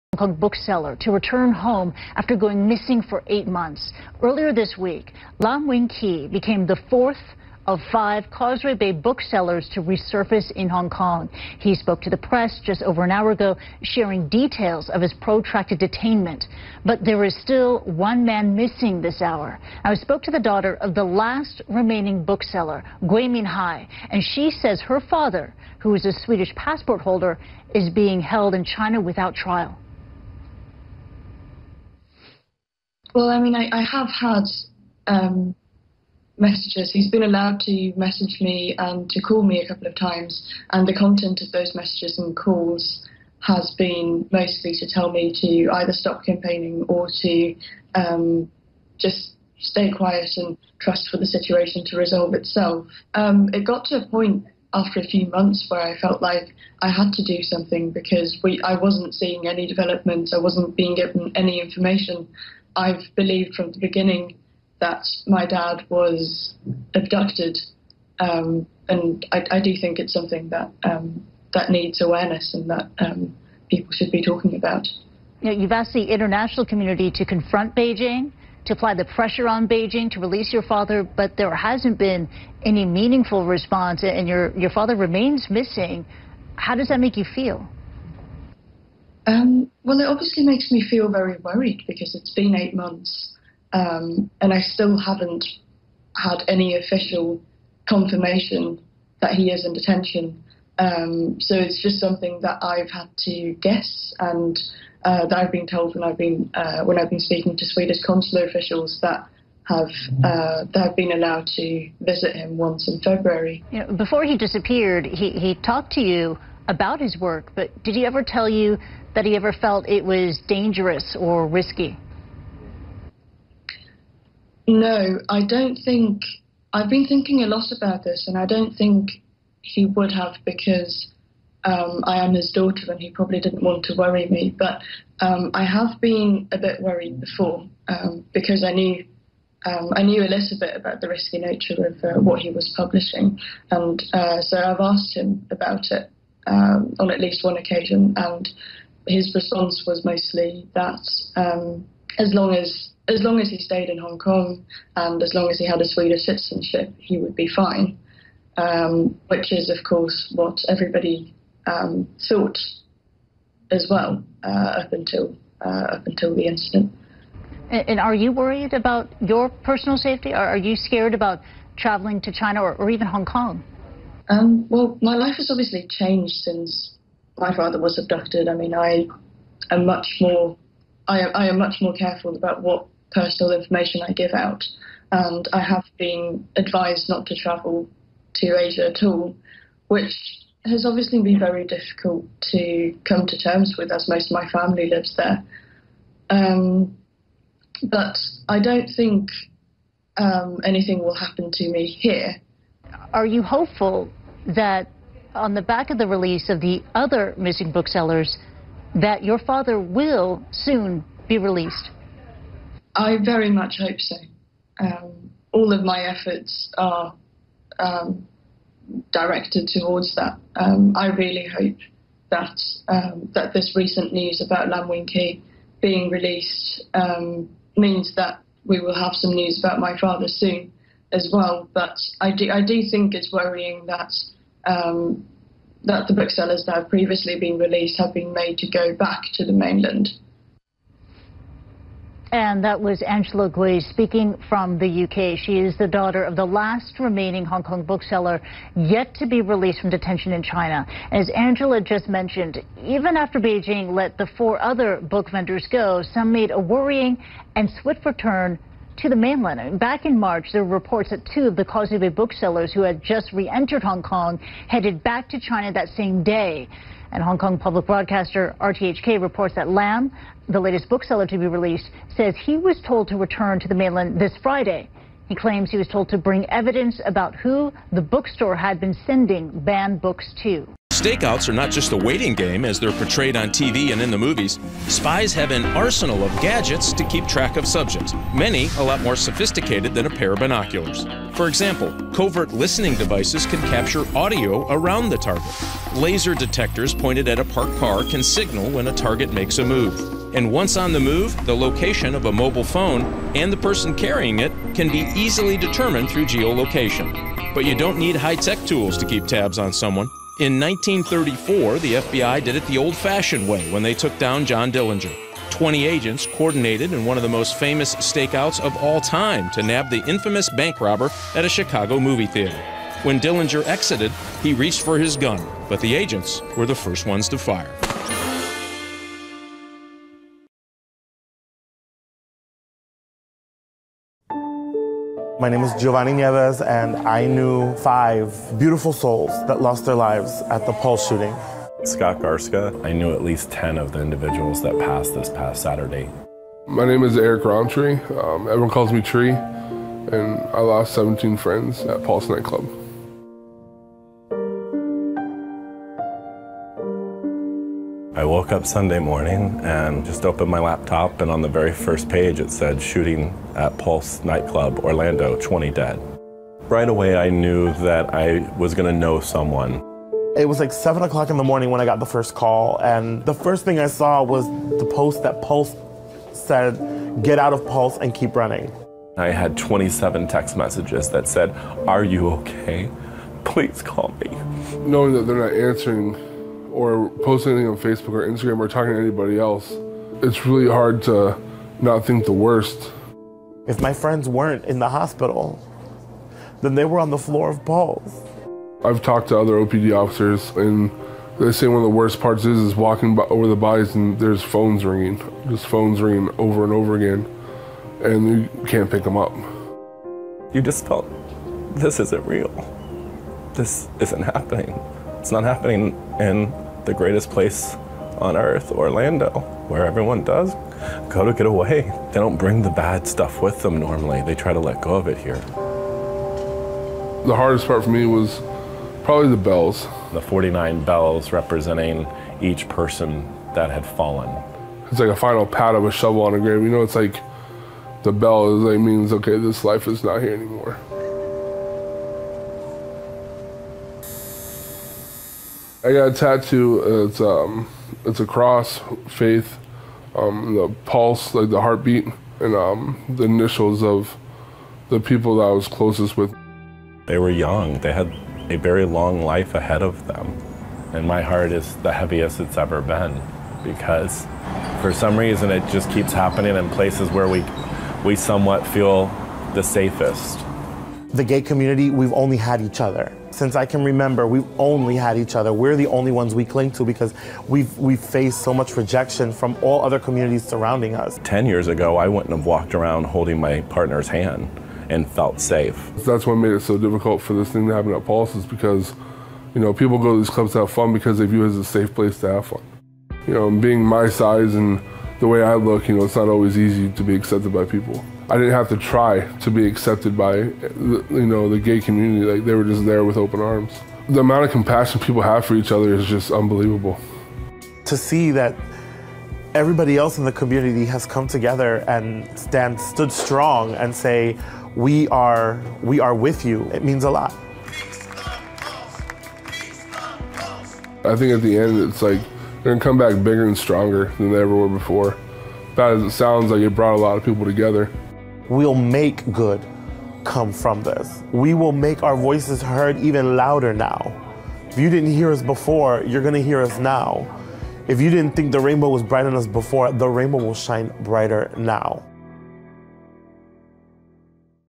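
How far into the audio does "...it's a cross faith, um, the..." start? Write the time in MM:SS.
07:28.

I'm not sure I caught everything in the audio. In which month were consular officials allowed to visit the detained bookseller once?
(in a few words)
February.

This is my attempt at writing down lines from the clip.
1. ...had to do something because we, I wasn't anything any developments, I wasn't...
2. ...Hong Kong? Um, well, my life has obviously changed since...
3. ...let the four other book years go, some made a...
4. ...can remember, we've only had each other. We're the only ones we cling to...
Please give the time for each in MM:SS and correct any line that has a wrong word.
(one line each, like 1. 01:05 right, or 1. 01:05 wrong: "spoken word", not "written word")
1. 00:56 wrong: "seeing", not "anything"
2. 02:53 right
3. 04:13 wrong: "vendors", not "years"
4. 07:53 right.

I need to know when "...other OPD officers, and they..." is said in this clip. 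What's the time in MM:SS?
06:39.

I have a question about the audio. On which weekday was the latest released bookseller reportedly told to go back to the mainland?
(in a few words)
Friday.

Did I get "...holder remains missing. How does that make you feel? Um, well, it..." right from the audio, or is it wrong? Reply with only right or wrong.
wrong.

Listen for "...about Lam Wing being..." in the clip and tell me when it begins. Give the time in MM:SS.
03:44.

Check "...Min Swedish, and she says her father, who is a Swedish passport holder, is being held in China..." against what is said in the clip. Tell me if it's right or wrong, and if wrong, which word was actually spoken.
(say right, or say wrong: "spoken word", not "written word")
wrong: "Hai", not "Swedish".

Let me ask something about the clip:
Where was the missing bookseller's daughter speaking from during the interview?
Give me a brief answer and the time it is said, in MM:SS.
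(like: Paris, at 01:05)
UK, at 04:04.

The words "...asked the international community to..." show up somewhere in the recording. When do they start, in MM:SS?
01:15.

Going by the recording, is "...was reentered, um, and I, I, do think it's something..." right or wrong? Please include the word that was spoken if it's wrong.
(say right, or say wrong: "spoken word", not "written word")
wrong: "abducted", not "reentered".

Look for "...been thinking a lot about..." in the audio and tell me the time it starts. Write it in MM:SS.
02:06.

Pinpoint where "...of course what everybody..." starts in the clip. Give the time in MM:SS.
02:39.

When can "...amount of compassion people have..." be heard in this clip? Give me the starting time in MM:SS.
08:24.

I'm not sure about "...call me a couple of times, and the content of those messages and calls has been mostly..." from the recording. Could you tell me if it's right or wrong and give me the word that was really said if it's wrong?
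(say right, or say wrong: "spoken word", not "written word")
right.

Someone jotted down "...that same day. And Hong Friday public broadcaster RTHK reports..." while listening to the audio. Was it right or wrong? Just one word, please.
wrong.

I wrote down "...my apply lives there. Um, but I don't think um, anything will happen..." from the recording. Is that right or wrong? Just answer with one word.
wrong.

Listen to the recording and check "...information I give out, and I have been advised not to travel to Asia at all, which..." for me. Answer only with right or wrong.
right.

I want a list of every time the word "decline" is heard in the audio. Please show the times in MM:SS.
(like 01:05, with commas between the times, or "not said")
not said.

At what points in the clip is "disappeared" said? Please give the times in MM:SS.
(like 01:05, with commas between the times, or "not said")
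01:54.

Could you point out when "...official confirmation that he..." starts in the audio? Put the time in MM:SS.
01:36.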